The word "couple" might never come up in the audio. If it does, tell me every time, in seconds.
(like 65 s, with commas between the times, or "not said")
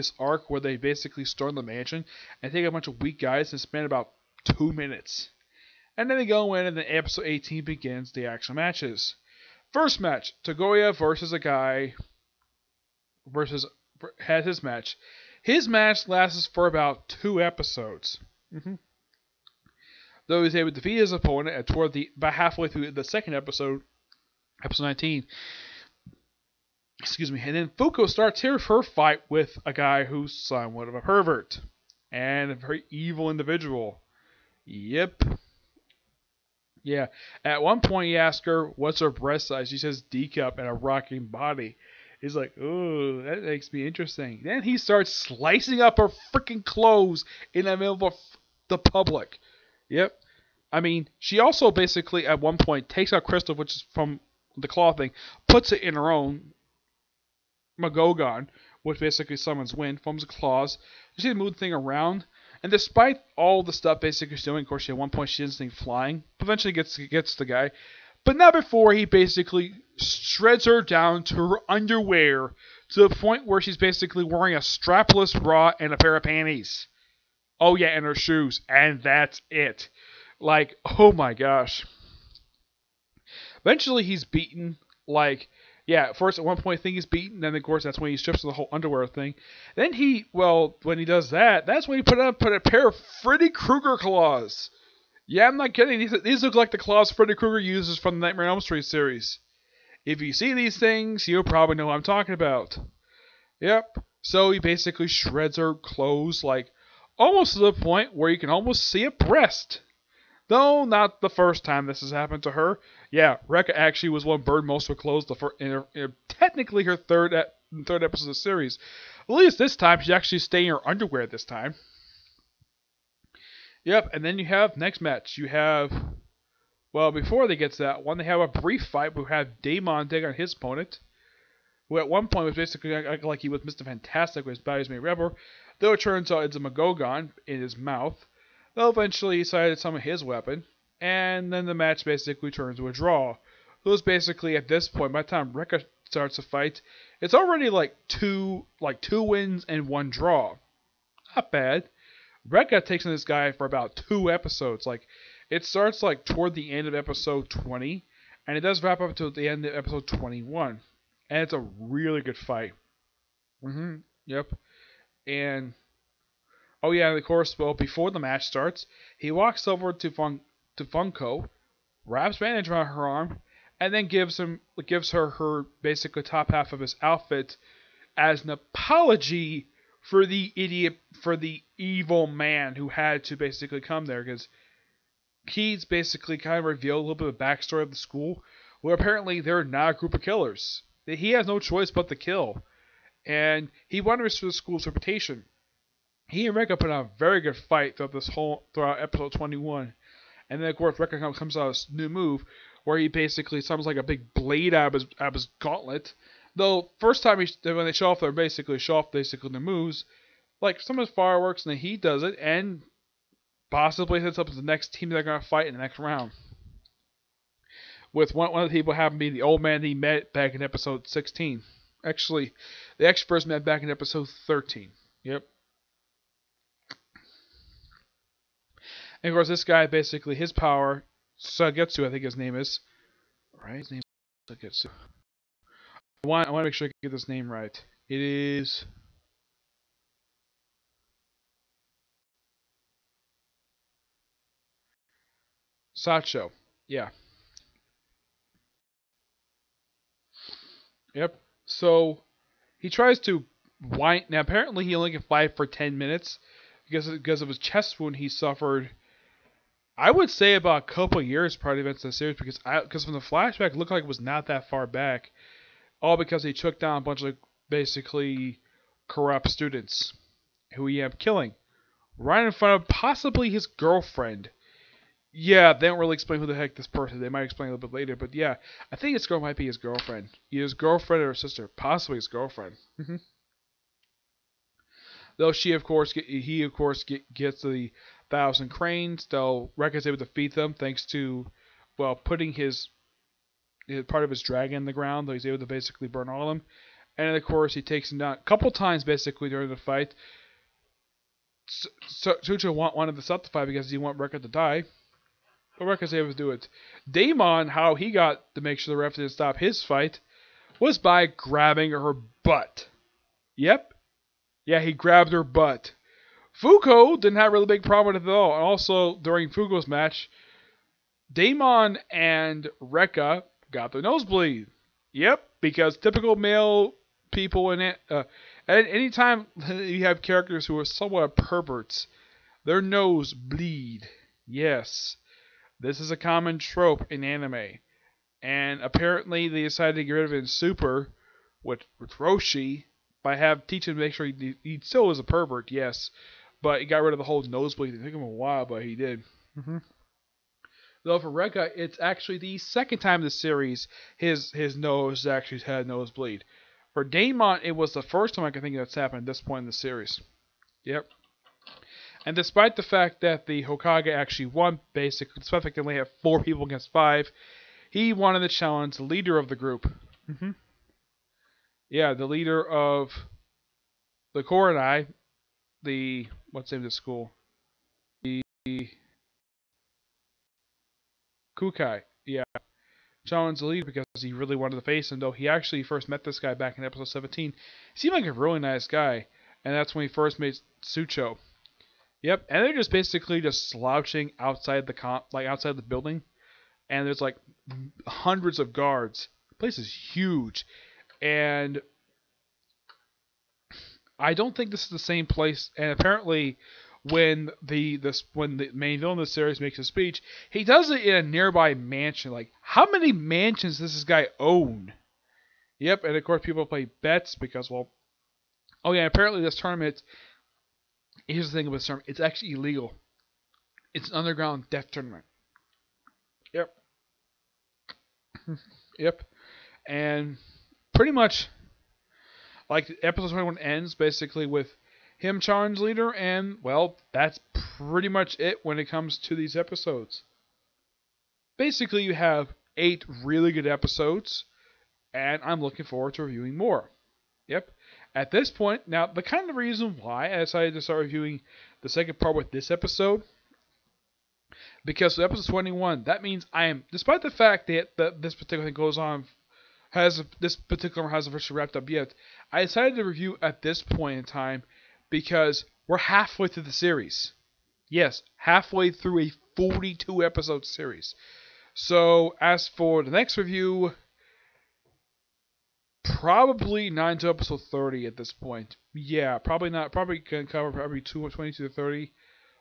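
260 s, 298 s.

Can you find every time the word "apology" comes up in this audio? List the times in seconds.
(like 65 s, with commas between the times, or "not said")
178 s.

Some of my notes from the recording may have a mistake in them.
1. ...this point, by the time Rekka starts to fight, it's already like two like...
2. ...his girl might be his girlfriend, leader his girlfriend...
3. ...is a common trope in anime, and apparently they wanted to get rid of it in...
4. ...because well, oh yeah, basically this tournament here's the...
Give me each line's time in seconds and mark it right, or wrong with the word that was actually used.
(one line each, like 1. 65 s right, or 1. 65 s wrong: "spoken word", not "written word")
1. 144 s right
2. 279 s wrong: "either", not "leader"
3. 335 s wrong: "decided", not "wanted"
4. 417 s wrong: "apparently", not "basically".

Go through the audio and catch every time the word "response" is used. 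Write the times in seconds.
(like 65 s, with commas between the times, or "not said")
not said.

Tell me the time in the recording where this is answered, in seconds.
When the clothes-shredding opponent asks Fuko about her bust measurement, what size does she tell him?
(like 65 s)
40 s.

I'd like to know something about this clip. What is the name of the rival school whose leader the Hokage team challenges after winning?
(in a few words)
Kukai.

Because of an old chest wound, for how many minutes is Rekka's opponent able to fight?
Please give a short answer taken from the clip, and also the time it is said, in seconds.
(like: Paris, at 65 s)
10, at 255 s.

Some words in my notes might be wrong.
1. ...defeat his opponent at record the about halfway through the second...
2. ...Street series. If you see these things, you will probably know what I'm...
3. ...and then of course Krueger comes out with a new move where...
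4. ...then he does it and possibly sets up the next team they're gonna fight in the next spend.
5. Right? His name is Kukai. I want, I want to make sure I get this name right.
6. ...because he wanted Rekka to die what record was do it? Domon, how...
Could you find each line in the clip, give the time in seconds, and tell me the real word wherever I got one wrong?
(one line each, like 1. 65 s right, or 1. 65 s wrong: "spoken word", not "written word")
1. 20 s wrong: "toward", not "record"
2. 98 s right
3. 200 s wrong: "Rekka", not "Krueger"
4. 211 s wrong: "round", not "spend"
5. 233 s wrong: "Sagetsu", not "Kukai"
6. 303 s right.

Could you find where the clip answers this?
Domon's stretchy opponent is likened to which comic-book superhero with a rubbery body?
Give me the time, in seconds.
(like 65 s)
133 s.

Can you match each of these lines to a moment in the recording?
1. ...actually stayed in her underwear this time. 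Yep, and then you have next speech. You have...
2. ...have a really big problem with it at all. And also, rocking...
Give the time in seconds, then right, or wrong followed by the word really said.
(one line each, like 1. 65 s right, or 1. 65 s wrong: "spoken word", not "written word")
1. 120 s wrong: "match", not "speech"
2. 317 s wrong: "during", not "rocking".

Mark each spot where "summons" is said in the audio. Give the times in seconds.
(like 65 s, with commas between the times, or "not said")
59 s, 203 s.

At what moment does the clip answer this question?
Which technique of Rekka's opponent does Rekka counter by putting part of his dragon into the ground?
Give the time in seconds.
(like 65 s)
288 s.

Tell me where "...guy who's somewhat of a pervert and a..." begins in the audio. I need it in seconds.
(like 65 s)
29 s.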